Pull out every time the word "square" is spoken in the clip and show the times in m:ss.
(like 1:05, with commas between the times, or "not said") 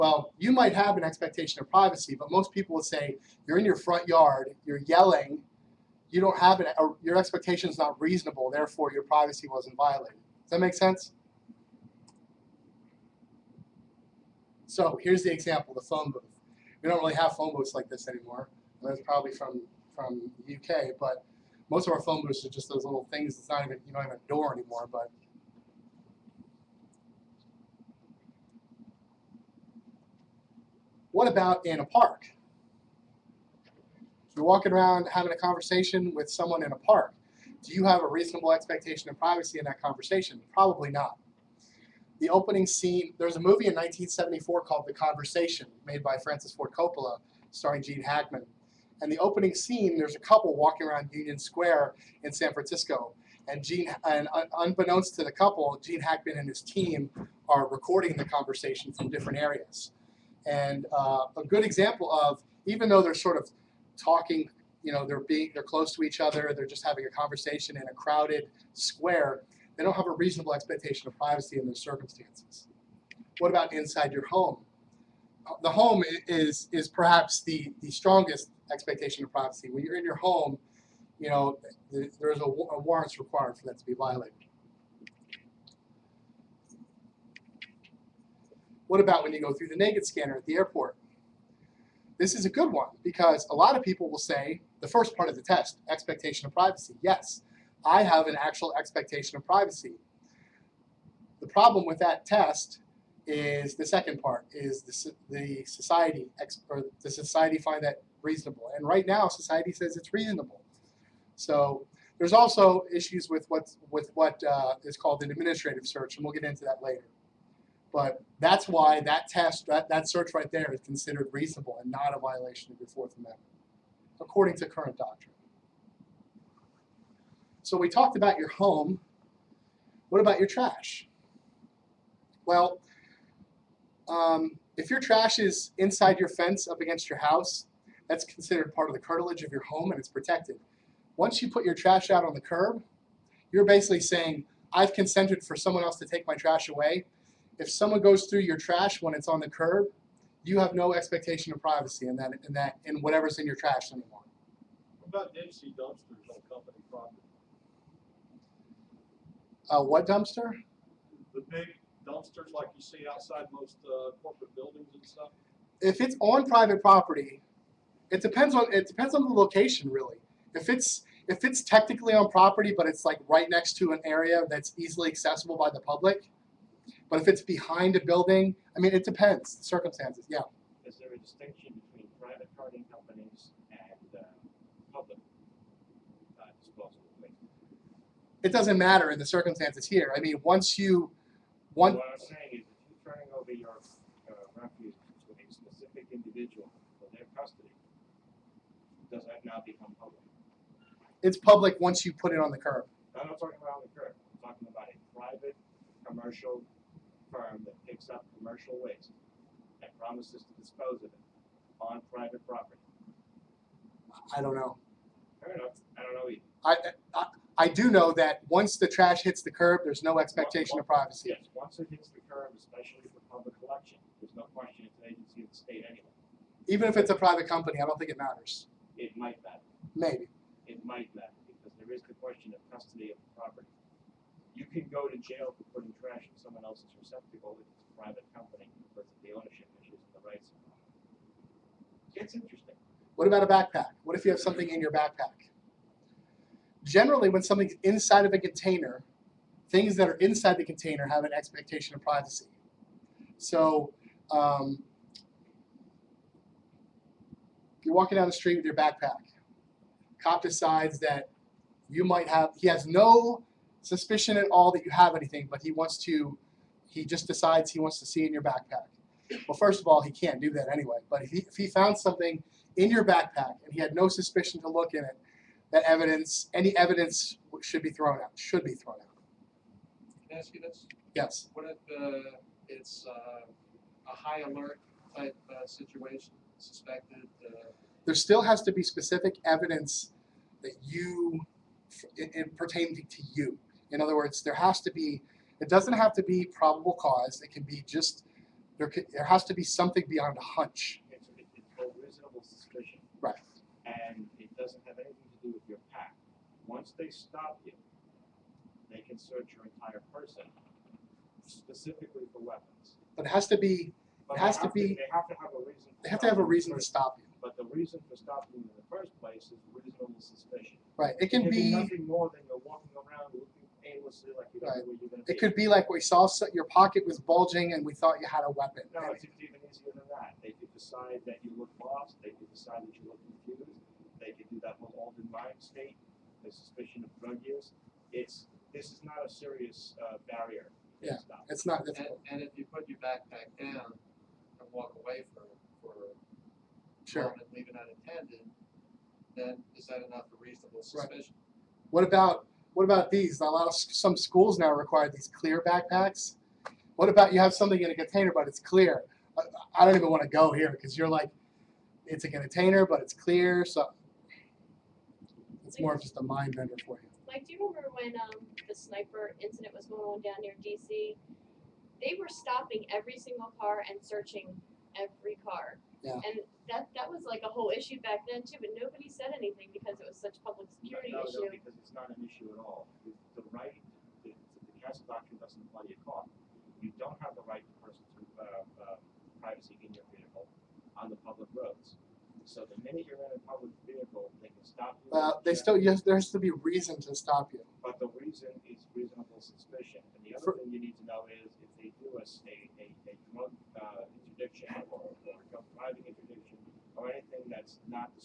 0:51, 1:08.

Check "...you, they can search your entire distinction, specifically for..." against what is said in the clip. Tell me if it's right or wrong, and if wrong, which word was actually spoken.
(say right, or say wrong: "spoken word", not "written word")
wrong: "person", not "distinction".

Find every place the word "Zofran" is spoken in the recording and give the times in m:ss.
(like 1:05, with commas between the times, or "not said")
not said.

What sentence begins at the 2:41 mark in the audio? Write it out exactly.
The big dumpsters like you see outside most uh, corporate buildings and stuff.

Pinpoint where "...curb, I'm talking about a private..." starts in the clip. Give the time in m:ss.
3:23.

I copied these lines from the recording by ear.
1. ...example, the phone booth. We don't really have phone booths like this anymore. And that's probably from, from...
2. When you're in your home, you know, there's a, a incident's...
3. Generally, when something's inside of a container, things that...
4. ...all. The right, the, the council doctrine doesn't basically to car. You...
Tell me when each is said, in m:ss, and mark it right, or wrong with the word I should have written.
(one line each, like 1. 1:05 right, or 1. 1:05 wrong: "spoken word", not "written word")
1. 0:15 right
2. 1:19 wrong: "warrant", not "incident"
3. 4:06 right
4. 6:22 wrong: "apply", not "basically".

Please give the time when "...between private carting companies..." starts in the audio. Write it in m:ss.
3:01.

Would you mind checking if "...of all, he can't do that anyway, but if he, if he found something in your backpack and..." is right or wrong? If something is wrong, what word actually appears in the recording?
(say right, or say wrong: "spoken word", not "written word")
right.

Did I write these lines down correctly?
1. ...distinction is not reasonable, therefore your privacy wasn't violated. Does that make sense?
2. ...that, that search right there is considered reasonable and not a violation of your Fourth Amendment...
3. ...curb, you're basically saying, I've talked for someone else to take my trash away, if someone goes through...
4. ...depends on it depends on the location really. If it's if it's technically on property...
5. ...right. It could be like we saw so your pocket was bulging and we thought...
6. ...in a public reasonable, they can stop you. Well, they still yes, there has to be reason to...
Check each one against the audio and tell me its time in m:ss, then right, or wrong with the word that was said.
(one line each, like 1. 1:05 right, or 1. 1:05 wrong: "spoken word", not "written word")
1. 0:07 wrong: "expectation", not "distinction"
2. 1:59 right
3. 2:22 wrong: "consented", not "talked"
4. 2:48 right
5. 5:24 right
6. 6:33 wrong: "vehicle", not "reasonable".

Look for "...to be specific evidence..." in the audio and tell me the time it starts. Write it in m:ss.
4:48.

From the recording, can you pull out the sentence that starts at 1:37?
Yes, I have an actual expectation of privacy.